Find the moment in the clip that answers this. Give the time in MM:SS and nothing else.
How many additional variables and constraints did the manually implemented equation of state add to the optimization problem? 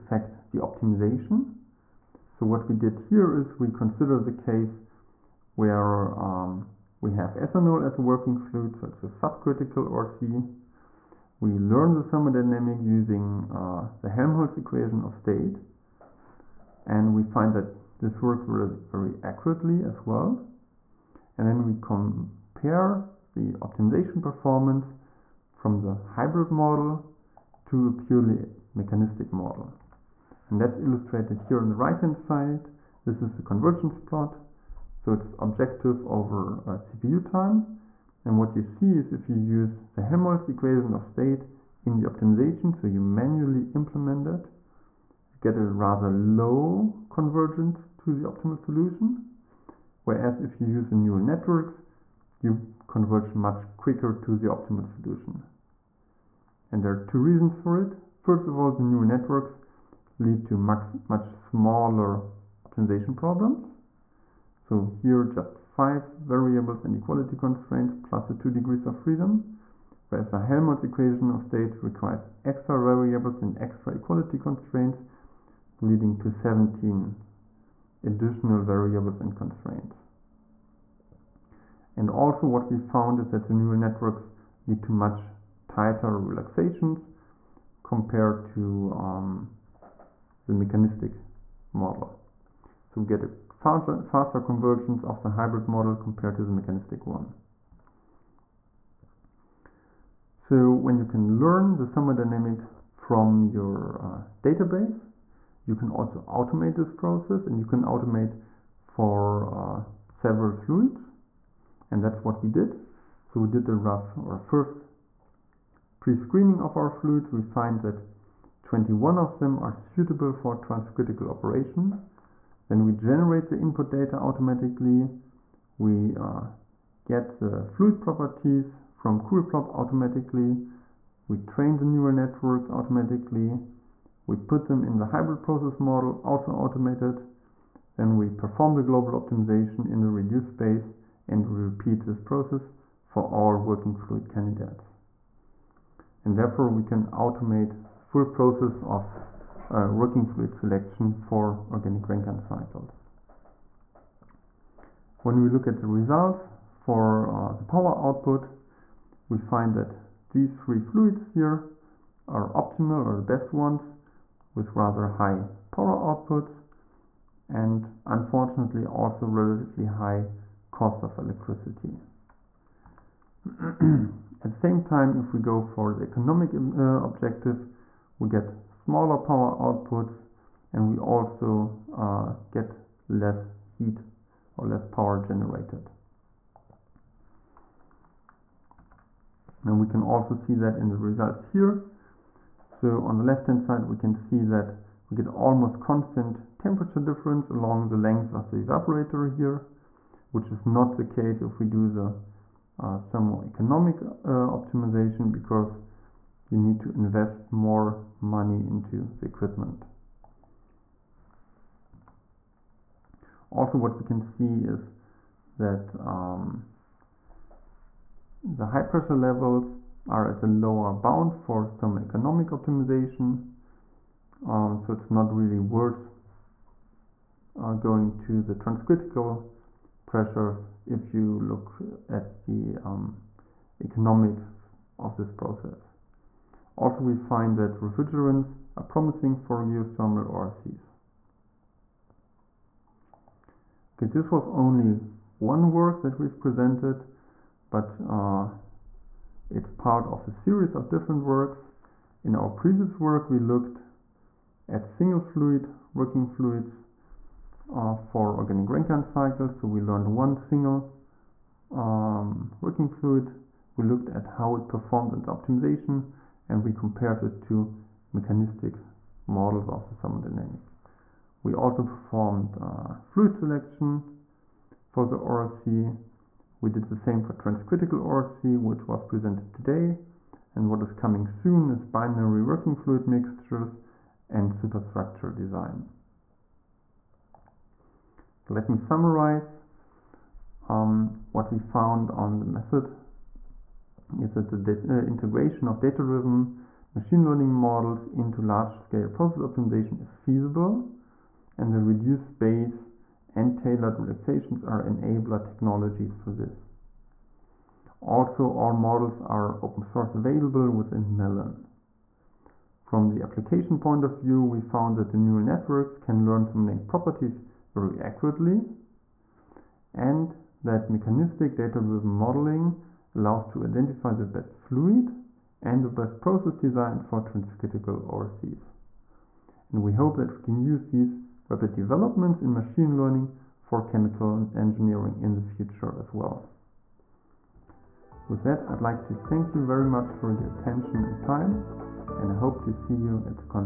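01:16.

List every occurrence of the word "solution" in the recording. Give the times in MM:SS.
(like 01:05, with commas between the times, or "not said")
00:48, 00:54.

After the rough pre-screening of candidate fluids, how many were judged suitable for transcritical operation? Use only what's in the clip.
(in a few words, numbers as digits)
21.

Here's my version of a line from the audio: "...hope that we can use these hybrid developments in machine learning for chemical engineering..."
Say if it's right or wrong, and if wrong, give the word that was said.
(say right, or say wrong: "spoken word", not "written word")
wrong: "rapid", not "hybrid".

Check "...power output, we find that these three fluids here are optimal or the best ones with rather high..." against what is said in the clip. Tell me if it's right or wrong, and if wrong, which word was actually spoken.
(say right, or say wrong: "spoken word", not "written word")
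right.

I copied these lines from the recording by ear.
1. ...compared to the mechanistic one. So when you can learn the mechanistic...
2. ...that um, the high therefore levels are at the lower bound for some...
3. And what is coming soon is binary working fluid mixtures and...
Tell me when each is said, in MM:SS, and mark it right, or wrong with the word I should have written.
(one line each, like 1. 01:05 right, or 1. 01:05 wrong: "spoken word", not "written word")
1. 01:35 wrong: "thermodynamic", not "mechanistic"
2. 03:35 wrong: "pressure", not "therefore"
3. 04:40 right.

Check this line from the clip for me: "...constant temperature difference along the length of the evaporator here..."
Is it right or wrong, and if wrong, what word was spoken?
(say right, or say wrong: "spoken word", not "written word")
right.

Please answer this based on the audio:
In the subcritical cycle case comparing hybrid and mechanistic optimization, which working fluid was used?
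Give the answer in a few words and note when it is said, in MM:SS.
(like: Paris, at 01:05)
Ethanol, at 00:07.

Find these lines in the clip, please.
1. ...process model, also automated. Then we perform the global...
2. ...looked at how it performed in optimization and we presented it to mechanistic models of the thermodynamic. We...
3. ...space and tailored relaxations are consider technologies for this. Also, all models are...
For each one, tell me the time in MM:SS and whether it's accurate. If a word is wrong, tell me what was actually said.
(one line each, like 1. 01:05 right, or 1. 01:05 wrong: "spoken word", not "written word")
1. 02:15 right
2. 04:23 wrong: "compared", not "presented"
3. 05:02 wrong: "enabler", not "consider".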